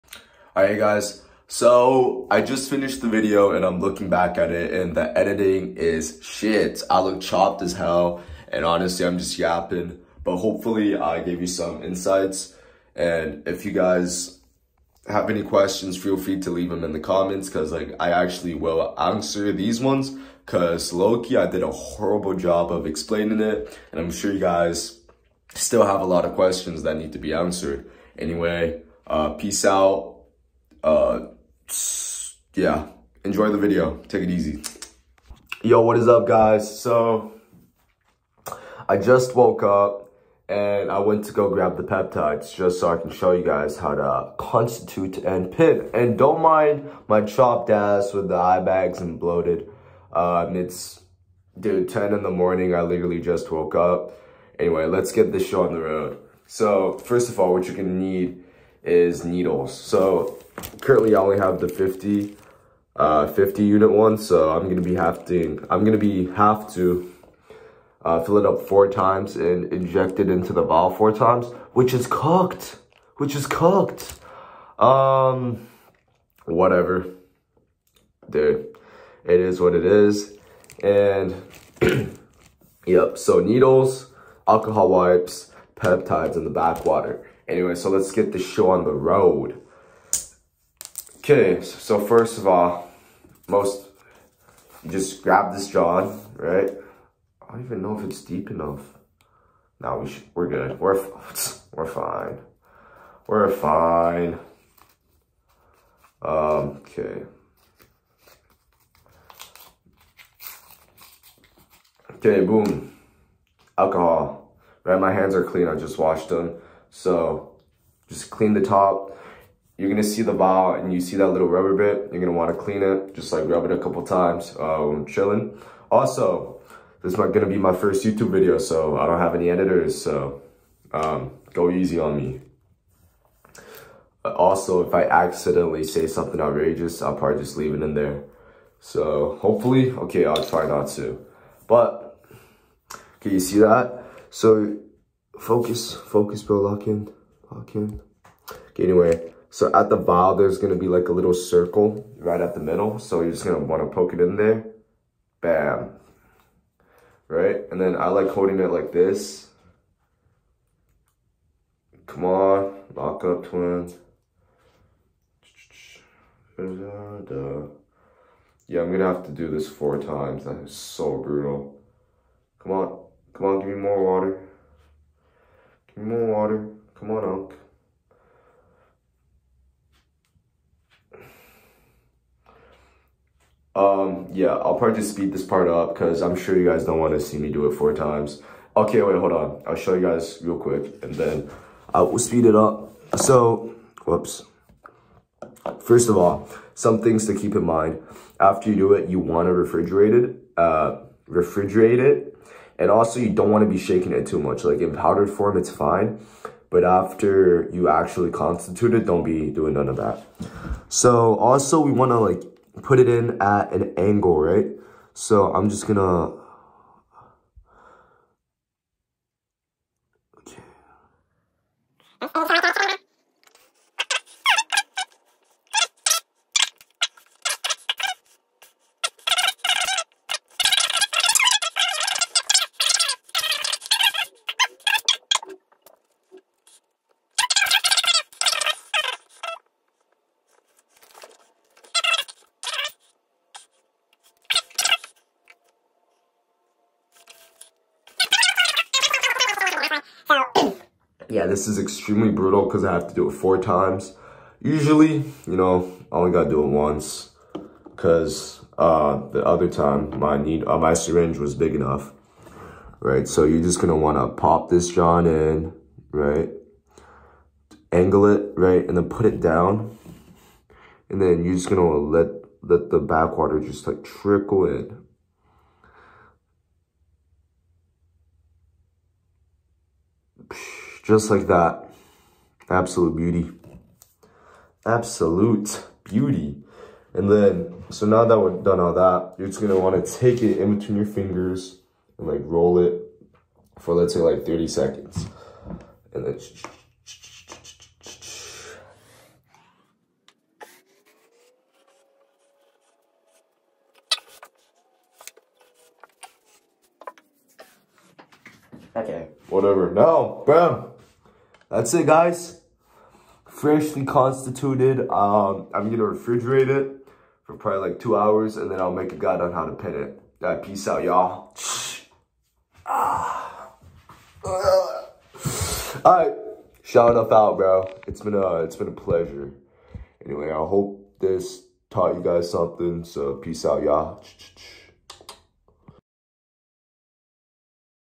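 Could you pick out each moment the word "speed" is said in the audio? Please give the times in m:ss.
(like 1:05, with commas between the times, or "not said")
3:05, 3:12.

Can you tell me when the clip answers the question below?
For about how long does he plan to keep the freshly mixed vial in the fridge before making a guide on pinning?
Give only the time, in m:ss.
5:17.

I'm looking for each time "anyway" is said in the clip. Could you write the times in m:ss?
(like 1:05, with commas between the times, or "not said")
0:28, 0:54, 1:27, 2:28, 5:30.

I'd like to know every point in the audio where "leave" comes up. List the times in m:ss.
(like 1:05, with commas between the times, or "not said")
0:16, 2:17.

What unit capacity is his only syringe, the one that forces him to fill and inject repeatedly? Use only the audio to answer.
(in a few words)
50 unit.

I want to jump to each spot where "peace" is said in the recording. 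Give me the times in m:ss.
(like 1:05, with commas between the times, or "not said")
0:29, 5:20, 5:33.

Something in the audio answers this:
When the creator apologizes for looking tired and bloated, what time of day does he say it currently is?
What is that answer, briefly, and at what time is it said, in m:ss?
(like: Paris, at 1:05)
10 in the morning, at 0:51.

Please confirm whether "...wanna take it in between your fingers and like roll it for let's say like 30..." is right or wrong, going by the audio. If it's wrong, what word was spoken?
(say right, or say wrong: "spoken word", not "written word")
right.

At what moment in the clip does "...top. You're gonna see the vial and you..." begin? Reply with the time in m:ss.
1:58.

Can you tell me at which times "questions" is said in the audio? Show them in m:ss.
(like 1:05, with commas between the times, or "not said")
0:15, 0:26.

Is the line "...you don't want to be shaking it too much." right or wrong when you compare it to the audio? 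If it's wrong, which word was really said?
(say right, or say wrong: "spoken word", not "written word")
right.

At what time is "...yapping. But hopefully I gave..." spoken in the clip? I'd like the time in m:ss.
0:09.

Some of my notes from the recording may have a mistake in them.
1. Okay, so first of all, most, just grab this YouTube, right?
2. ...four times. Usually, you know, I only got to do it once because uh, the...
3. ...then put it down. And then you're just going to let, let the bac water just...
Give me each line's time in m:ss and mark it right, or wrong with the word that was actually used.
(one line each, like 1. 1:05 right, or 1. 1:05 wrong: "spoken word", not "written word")
1. 1:31 wrong: "John", not "YouTube"
2. 4:13 right
3. 4:28 right.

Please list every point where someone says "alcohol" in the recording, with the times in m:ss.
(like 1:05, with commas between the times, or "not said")
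1:24, 1:53.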